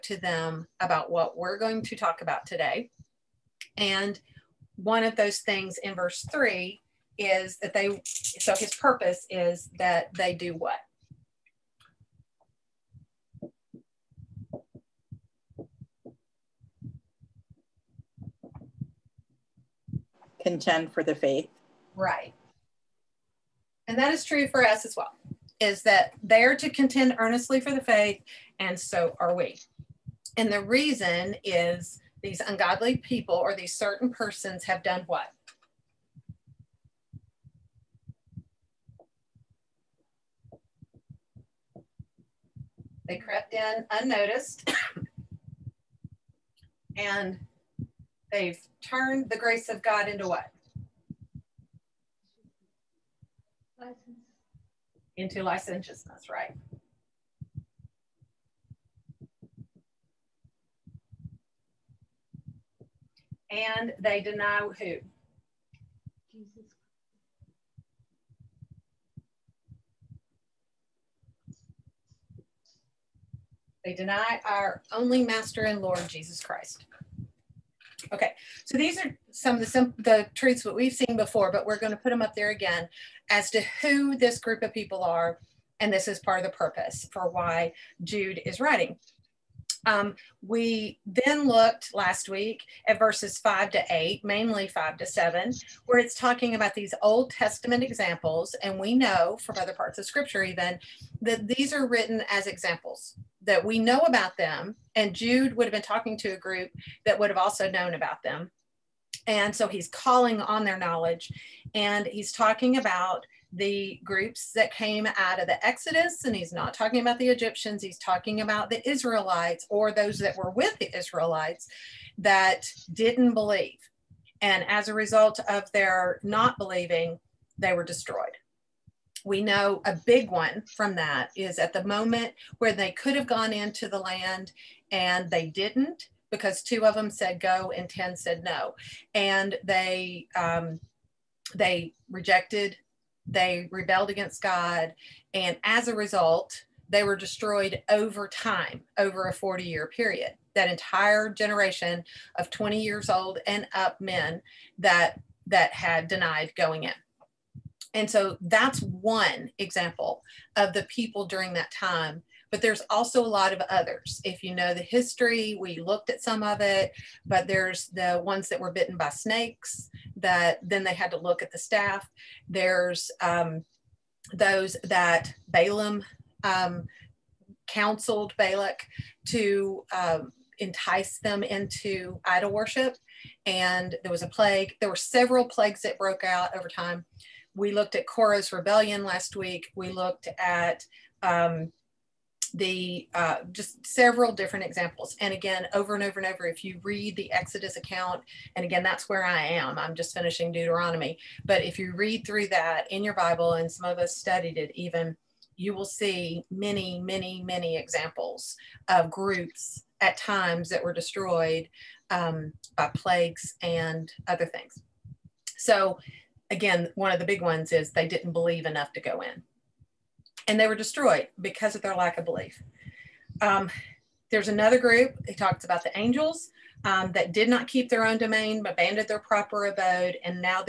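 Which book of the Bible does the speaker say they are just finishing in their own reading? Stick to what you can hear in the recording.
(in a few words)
Deuteronomy.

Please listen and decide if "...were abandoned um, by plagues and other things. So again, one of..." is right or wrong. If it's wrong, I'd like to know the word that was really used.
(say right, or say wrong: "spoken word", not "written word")
wrong: "destroyed", not "abandoned".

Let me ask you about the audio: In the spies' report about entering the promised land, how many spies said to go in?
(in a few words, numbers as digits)
2.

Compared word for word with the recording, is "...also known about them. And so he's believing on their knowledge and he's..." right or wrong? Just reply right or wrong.
wrong.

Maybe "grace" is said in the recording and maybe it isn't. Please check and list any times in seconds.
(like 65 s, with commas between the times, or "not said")
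49 s.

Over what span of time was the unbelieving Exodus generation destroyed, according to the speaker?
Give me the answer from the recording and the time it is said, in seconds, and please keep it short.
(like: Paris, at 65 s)
40 years, at 149 s.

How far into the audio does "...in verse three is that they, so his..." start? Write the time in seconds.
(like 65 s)
5 s.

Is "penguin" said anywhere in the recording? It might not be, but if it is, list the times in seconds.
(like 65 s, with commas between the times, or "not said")
not said.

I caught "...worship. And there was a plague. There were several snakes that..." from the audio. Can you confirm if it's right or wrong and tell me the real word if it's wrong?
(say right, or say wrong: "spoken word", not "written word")
wrong: "plagues", not "snakes".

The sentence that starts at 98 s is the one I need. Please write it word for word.
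And we know from other parts of scripture, even, that these are written as examples that we know about them.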